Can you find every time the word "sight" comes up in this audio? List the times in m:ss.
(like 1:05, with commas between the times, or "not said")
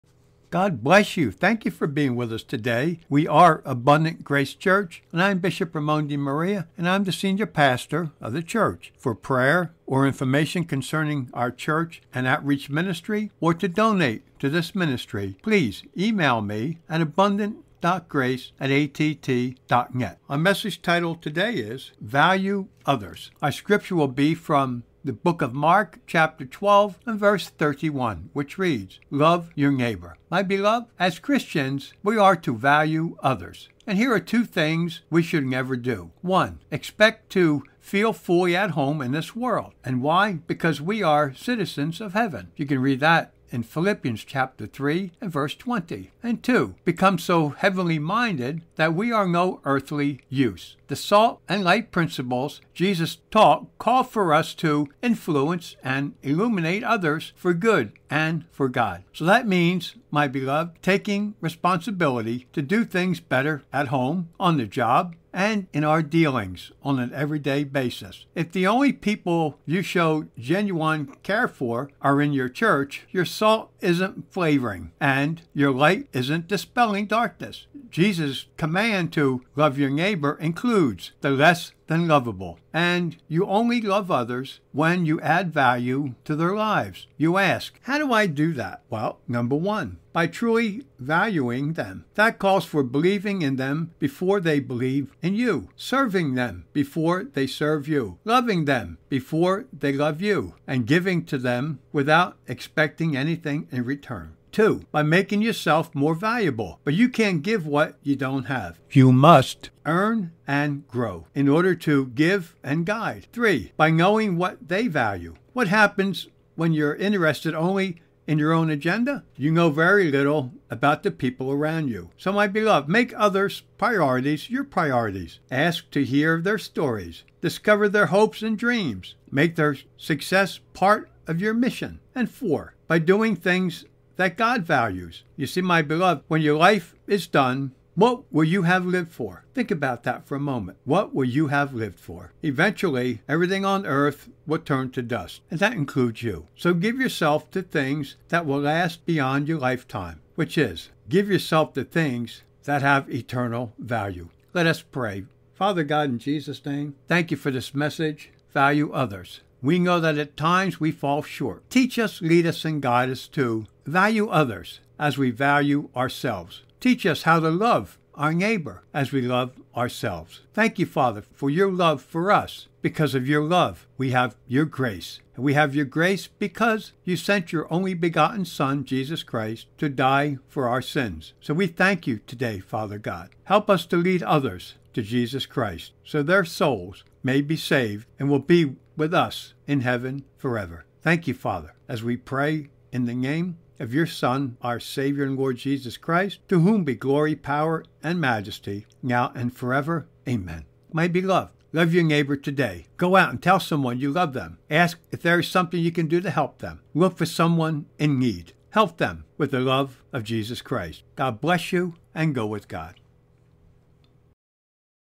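not said.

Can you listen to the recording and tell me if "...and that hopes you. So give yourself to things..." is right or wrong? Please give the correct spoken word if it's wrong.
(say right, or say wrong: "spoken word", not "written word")
wrong: "includes", not "hopes".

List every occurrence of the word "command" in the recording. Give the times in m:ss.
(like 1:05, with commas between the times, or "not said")
1:18.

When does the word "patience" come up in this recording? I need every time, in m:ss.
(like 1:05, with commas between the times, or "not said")
not said.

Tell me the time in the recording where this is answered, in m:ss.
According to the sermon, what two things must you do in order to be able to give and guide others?
1:49.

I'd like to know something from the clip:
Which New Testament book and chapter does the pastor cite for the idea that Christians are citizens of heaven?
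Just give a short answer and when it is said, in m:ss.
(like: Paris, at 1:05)
Philippians chapter 3, at 0:43.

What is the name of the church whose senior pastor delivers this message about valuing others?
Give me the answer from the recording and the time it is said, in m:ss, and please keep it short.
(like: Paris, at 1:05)
Abundant Grace Church, at 0:03.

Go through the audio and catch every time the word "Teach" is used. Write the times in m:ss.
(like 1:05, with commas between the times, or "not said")
2:41, 2:46.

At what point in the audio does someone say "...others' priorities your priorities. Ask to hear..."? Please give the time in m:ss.
2:03.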